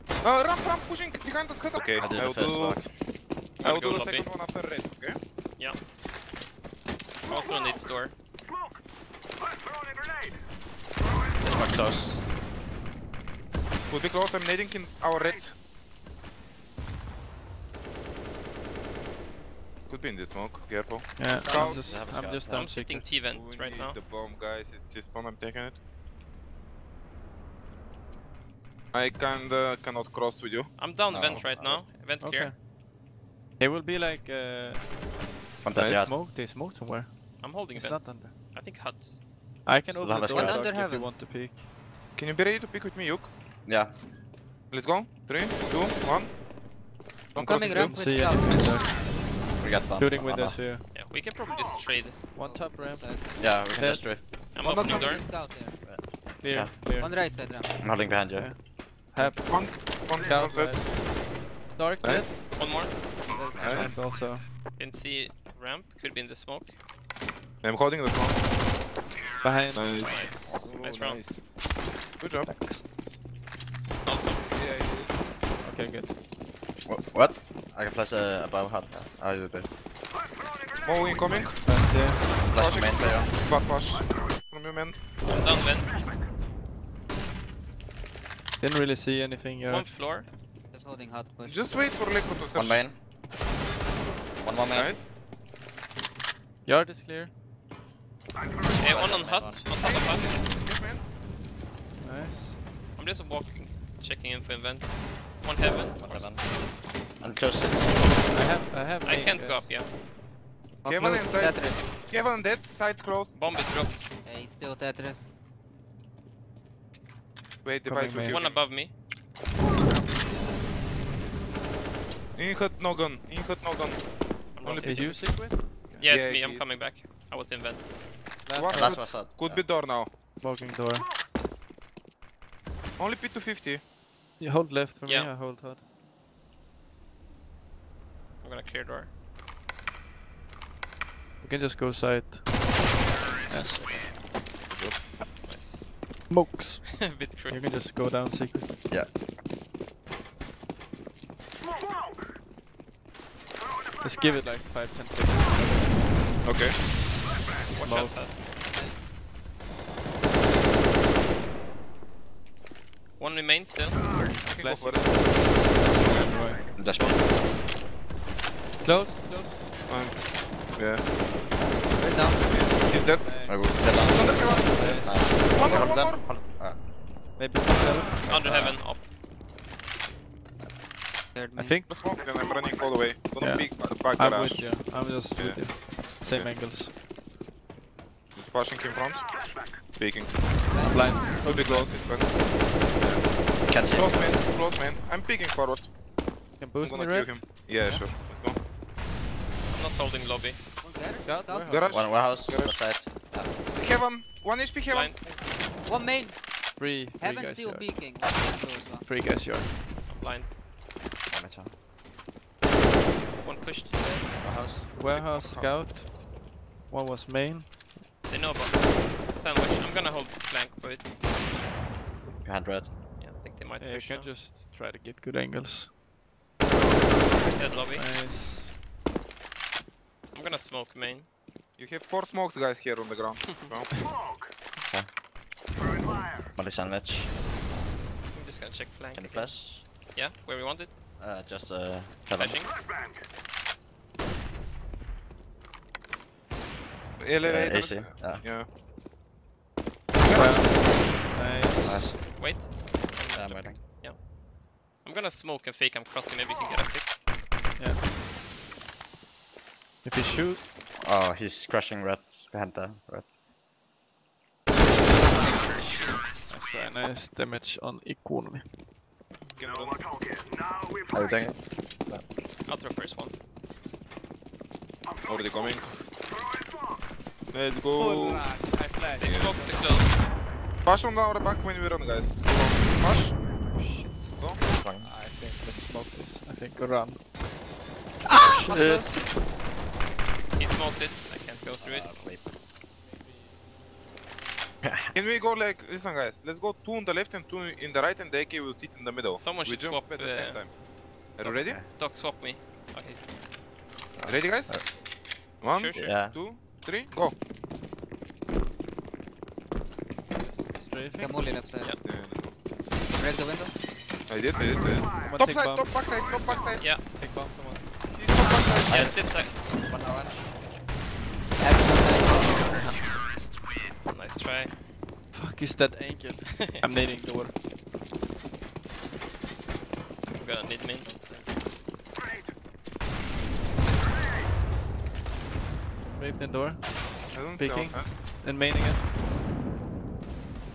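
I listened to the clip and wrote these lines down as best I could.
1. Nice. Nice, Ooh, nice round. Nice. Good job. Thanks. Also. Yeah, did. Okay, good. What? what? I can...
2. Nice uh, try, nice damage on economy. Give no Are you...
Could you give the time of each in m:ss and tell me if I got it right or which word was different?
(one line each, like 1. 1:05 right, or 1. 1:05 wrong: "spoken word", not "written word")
1. 1:09 right
2. 4:24 right.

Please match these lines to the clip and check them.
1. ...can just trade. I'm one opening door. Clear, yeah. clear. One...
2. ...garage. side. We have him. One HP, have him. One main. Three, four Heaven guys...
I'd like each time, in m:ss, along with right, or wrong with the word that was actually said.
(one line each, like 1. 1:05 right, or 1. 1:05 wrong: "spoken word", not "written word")
1. 0:53 right
2. 3:22 wrong: "three", not "four".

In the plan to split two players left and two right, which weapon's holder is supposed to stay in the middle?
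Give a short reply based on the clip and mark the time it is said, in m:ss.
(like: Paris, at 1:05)
AK, at 4:58.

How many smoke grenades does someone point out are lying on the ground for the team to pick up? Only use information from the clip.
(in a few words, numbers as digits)
4.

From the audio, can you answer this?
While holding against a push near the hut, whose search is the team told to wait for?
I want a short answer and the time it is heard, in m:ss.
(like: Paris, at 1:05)
Liquid, at 1:32.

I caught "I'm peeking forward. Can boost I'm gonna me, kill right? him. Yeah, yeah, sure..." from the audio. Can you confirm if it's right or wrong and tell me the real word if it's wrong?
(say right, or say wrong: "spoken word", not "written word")
right.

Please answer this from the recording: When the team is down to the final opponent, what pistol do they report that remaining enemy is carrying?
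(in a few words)
P250.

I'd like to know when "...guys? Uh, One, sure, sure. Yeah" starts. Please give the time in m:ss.
5:04.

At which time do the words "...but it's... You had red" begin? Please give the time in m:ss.
3:40.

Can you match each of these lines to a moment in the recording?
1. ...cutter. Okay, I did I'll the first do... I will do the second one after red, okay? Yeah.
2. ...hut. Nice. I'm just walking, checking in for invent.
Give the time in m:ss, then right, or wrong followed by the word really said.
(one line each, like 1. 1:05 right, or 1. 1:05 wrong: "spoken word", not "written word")
1. 0:01 right
2. 1:39 right.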